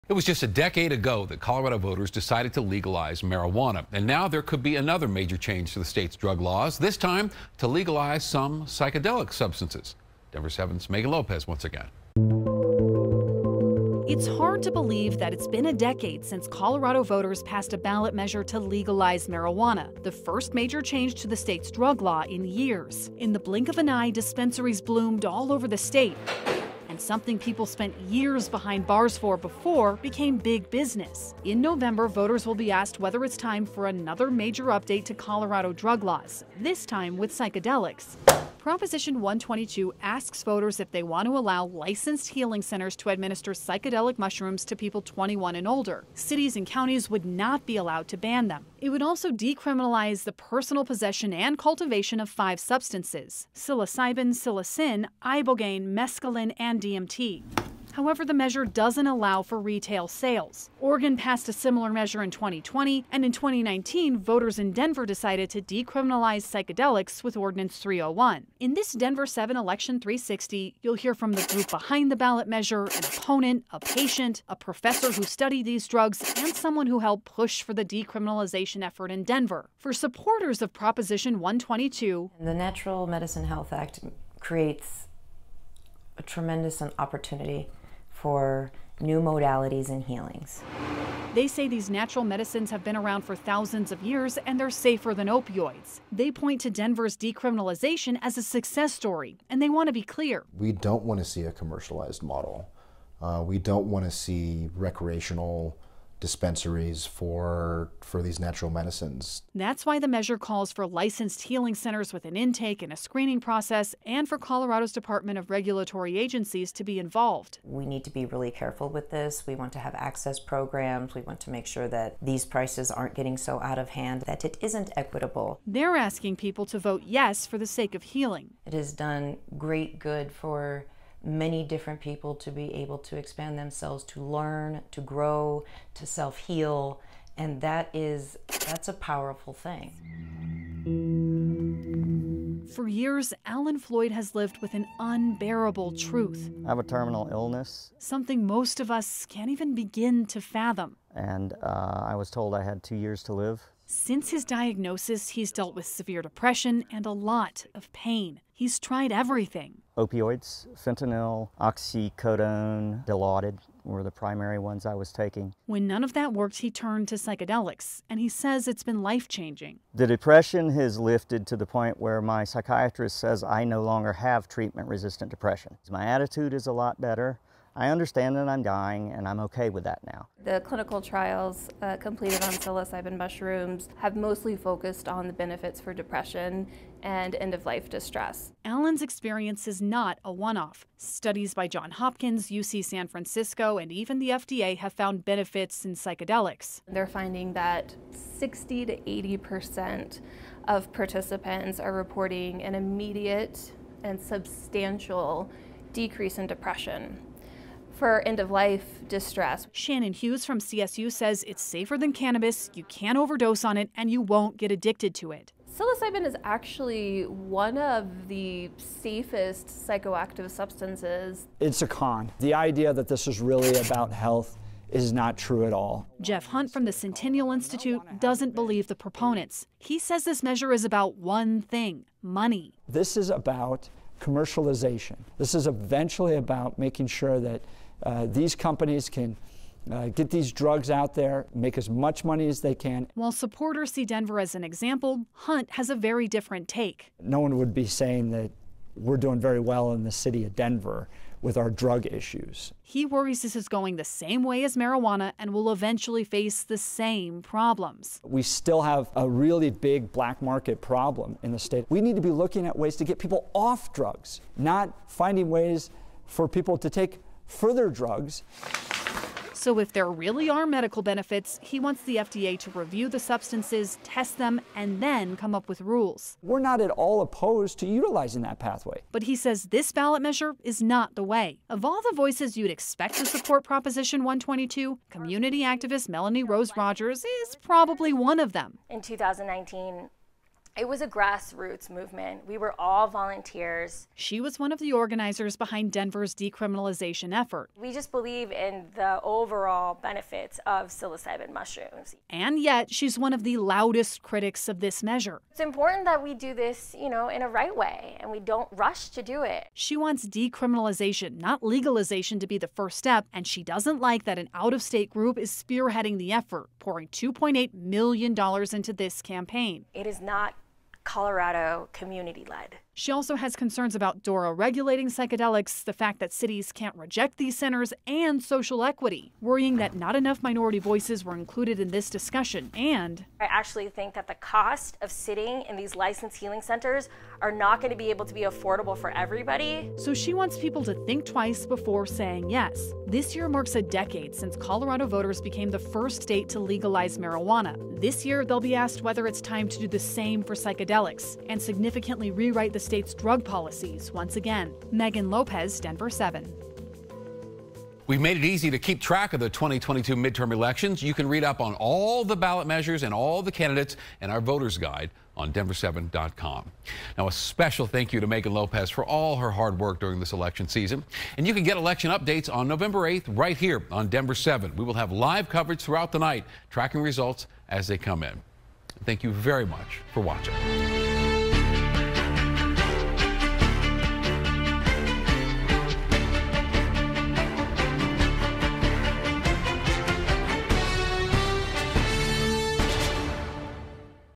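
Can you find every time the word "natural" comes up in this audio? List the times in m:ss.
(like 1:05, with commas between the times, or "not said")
1:22, 1:31, 1:48.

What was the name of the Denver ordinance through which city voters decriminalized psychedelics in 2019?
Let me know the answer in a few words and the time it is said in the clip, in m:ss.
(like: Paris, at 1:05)
Ordinance 301, at 1:07.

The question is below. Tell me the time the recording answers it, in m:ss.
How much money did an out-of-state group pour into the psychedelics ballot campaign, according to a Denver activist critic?
5:17.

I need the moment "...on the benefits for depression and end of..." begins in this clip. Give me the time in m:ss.
3:05.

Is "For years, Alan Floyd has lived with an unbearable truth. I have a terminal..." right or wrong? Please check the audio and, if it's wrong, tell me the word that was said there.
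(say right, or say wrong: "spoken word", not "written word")
right.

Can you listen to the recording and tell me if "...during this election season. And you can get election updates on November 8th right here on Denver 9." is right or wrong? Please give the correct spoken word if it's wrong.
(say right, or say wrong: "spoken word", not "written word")
wrong: "7", not "9".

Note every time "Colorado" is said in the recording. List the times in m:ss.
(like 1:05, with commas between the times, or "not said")
0:01, 0:16, 0:35, 1:54, 5:21, 5:44.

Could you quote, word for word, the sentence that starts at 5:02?
And yet, she's one of the loudest critics of this measure.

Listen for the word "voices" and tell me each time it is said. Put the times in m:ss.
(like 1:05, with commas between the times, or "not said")
4:42, 5:30.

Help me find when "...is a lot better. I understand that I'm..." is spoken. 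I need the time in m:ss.
2:56.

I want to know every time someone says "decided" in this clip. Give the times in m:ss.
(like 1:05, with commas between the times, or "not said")
0:02, 1:05.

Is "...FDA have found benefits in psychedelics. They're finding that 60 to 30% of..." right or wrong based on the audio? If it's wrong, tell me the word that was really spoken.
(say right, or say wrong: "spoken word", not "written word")
wrong: "80", not "30".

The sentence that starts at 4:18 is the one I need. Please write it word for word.
We still have a really big black market problem in the state.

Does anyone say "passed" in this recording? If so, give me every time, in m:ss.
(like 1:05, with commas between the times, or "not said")
0:17, 1:01.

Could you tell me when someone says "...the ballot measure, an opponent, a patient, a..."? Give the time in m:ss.
1:12.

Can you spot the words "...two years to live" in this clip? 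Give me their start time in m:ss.
2:32.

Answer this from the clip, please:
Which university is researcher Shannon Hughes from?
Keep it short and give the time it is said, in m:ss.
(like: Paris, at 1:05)
CSU, at 3:30.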